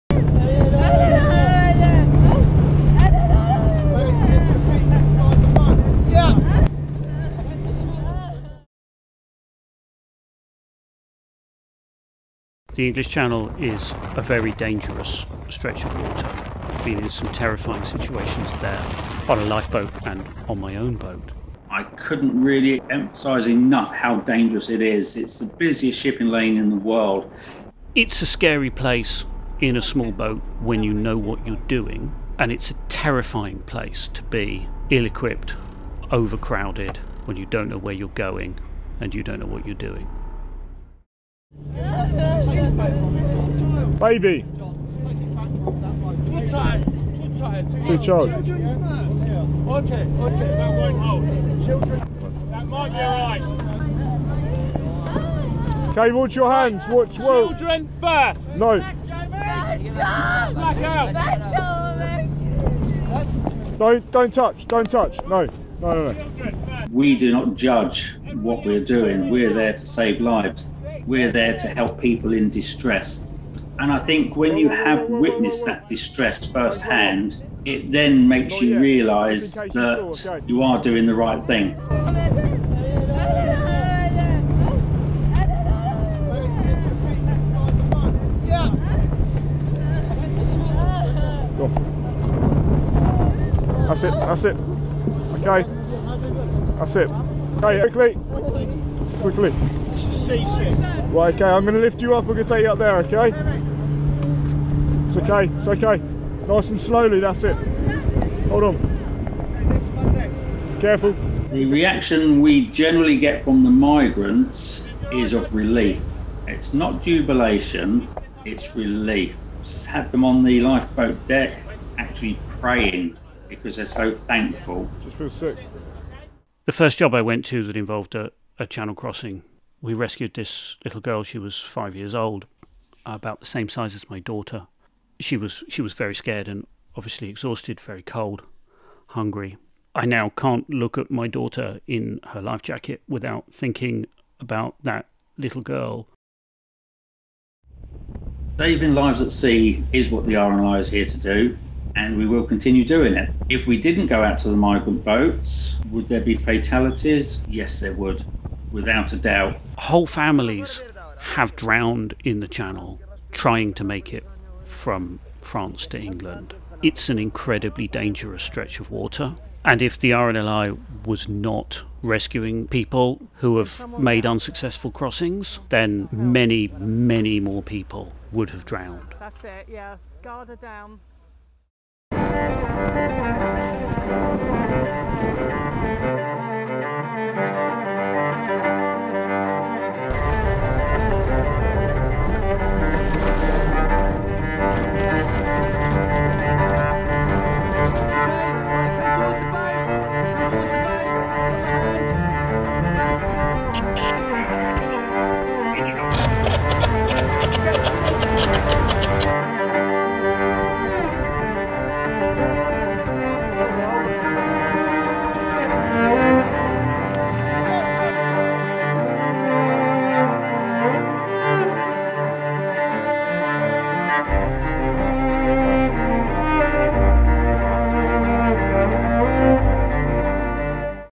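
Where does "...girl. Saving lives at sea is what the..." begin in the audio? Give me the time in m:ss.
2:25.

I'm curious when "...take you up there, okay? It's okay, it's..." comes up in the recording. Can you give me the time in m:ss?
1:42.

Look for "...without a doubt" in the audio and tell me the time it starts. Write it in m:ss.
2:38.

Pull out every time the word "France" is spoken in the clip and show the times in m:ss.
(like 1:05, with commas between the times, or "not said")
2:45.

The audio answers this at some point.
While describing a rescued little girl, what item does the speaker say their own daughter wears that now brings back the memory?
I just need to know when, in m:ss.
2:22.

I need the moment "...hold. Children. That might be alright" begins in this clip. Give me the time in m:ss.
0:50.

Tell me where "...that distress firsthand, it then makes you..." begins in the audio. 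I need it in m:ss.
1:15.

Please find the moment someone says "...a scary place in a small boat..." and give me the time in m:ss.
0:28.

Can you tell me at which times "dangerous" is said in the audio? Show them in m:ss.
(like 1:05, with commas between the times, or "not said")
0:14, 0:24, 2:47.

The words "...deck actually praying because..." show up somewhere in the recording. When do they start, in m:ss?
2:01.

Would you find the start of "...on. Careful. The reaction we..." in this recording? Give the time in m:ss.
1:48.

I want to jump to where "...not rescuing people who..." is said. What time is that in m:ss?
2:51.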